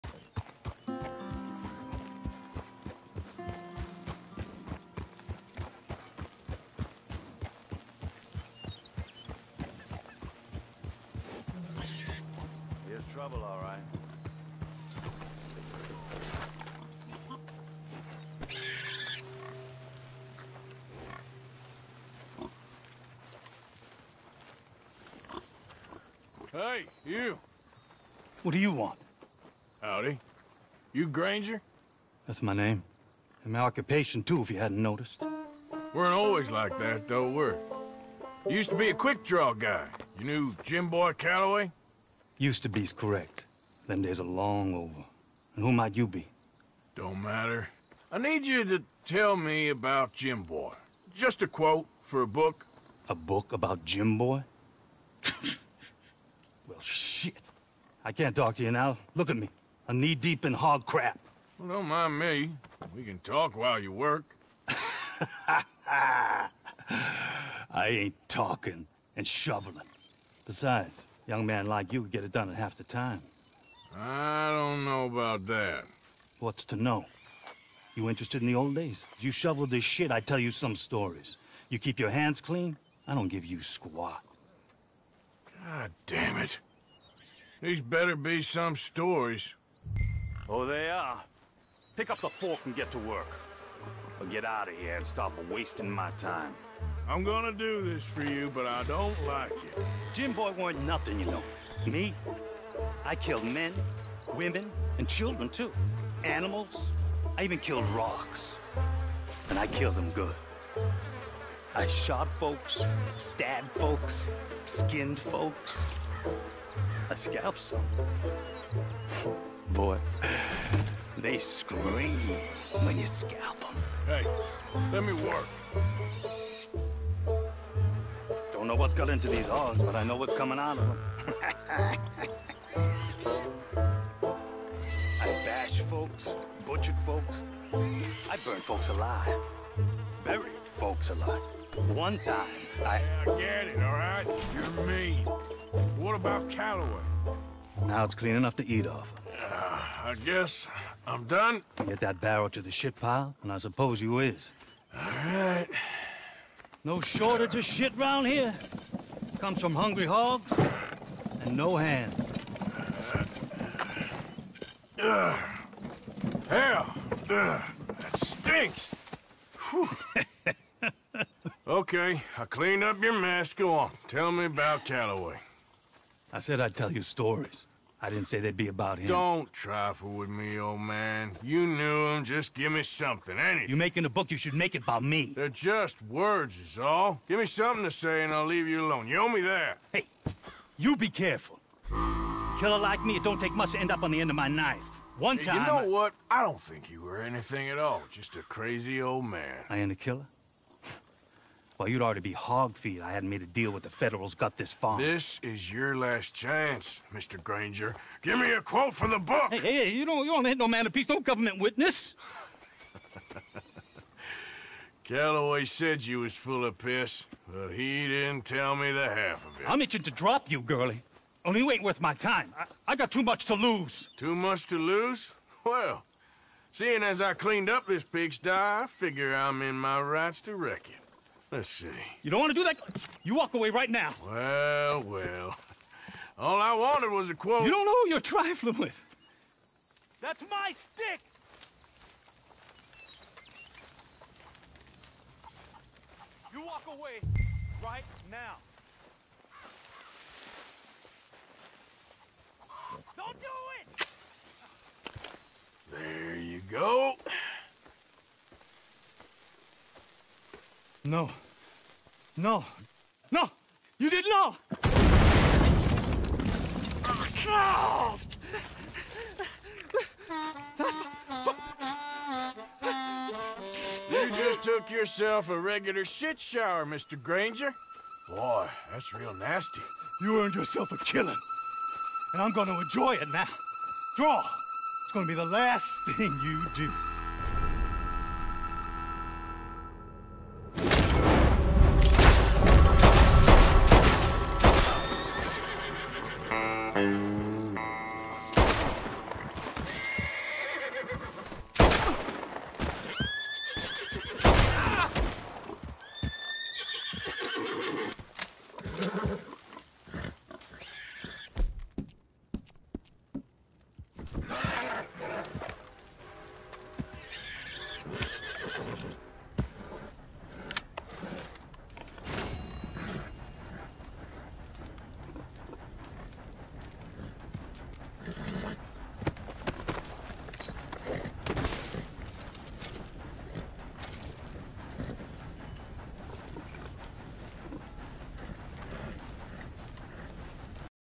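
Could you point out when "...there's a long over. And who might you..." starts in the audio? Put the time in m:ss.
0:44.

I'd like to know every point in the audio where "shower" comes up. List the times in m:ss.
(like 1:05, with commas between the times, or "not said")
4:36.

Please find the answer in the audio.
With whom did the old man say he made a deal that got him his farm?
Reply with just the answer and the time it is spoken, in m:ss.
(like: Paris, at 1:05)
The Federals, at 3:23.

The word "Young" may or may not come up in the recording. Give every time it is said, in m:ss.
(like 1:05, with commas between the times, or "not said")
1:11.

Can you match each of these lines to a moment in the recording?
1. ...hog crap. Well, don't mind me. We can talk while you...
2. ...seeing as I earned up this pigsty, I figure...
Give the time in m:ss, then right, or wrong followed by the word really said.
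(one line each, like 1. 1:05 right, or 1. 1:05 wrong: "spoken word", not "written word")
1. 1:00 right
2. 3:46 wrong: "cleaned", not "earned".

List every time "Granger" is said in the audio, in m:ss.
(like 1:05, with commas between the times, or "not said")
0:31, 3:27, 4:37.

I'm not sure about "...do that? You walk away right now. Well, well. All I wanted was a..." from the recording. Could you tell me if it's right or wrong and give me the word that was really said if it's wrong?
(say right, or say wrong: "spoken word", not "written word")
right.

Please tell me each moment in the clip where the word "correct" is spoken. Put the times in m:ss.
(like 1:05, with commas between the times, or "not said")
0:42.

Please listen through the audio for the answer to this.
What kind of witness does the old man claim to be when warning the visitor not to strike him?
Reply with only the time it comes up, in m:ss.
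3:31.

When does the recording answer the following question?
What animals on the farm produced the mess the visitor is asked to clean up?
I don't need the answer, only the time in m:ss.
2:39.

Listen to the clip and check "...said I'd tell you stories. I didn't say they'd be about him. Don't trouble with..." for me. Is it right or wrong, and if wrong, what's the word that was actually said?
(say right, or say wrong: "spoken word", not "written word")
wrong: "trifle", not "trouble".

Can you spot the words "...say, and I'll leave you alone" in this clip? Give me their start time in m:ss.
3:07.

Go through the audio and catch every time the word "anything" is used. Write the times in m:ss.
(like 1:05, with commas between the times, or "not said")
3:03, 3:17.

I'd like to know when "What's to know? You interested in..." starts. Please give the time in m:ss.
1:16.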